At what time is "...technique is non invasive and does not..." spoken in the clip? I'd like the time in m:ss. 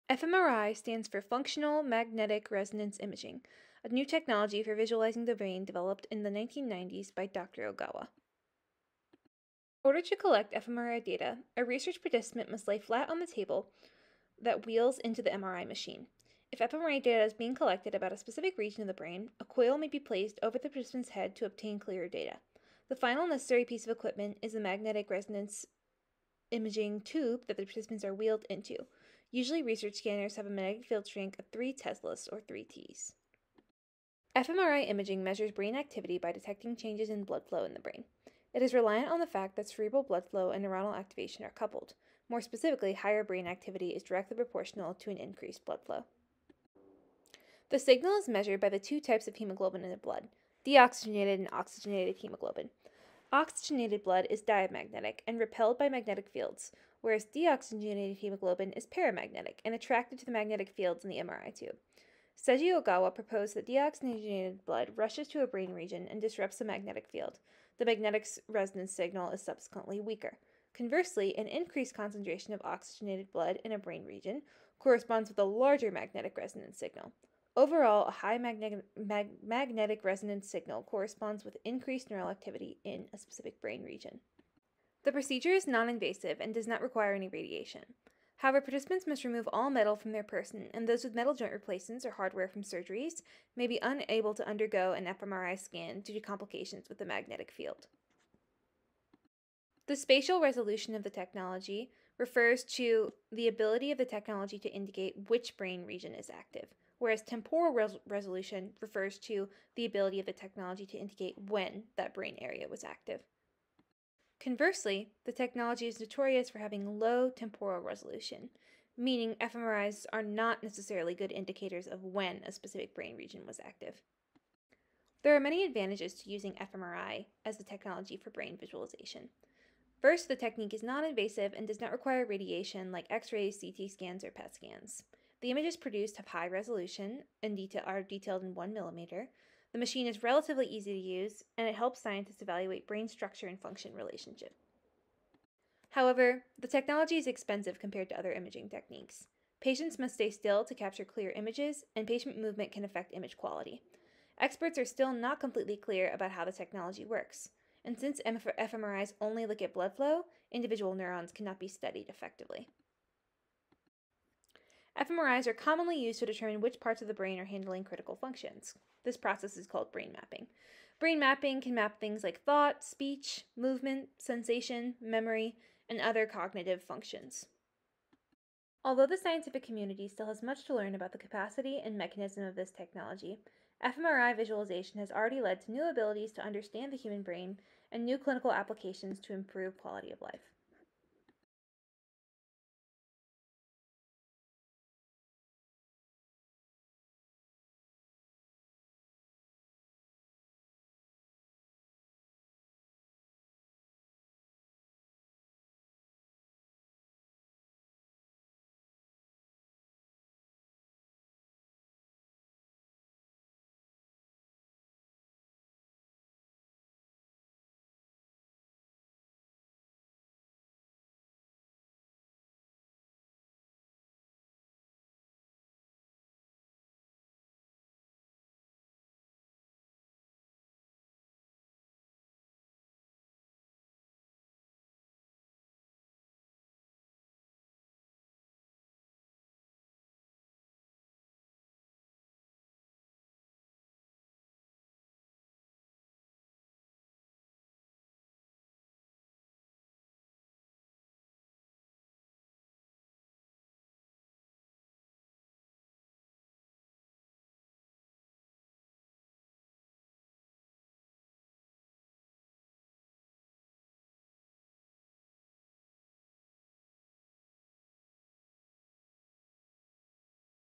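2:10.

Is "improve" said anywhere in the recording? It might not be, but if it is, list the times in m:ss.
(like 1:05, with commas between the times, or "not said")
3:09.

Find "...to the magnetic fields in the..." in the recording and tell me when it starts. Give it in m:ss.
1:00.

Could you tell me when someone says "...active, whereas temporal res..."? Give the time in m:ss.
1:46.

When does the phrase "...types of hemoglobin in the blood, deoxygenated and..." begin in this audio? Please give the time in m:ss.
0:48.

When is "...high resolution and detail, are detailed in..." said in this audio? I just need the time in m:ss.
2:16.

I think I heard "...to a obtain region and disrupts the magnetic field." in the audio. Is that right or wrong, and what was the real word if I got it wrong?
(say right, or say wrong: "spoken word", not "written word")
wrong: "brain", not "obtain".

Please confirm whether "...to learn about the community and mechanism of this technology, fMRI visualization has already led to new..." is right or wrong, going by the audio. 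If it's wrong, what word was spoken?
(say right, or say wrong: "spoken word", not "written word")
wrong: "capacity", not "community".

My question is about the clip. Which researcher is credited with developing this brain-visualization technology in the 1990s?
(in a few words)
Dr. Ogawa.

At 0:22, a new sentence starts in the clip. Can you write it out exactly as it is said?
The final necessary piece of equipment is the magnetic resonance imaging tube that the participants are wheeled into.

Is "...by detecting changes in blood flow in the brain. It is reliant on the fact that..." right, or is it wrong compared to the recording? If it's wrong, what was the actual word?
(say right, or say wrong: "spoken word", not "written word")
right.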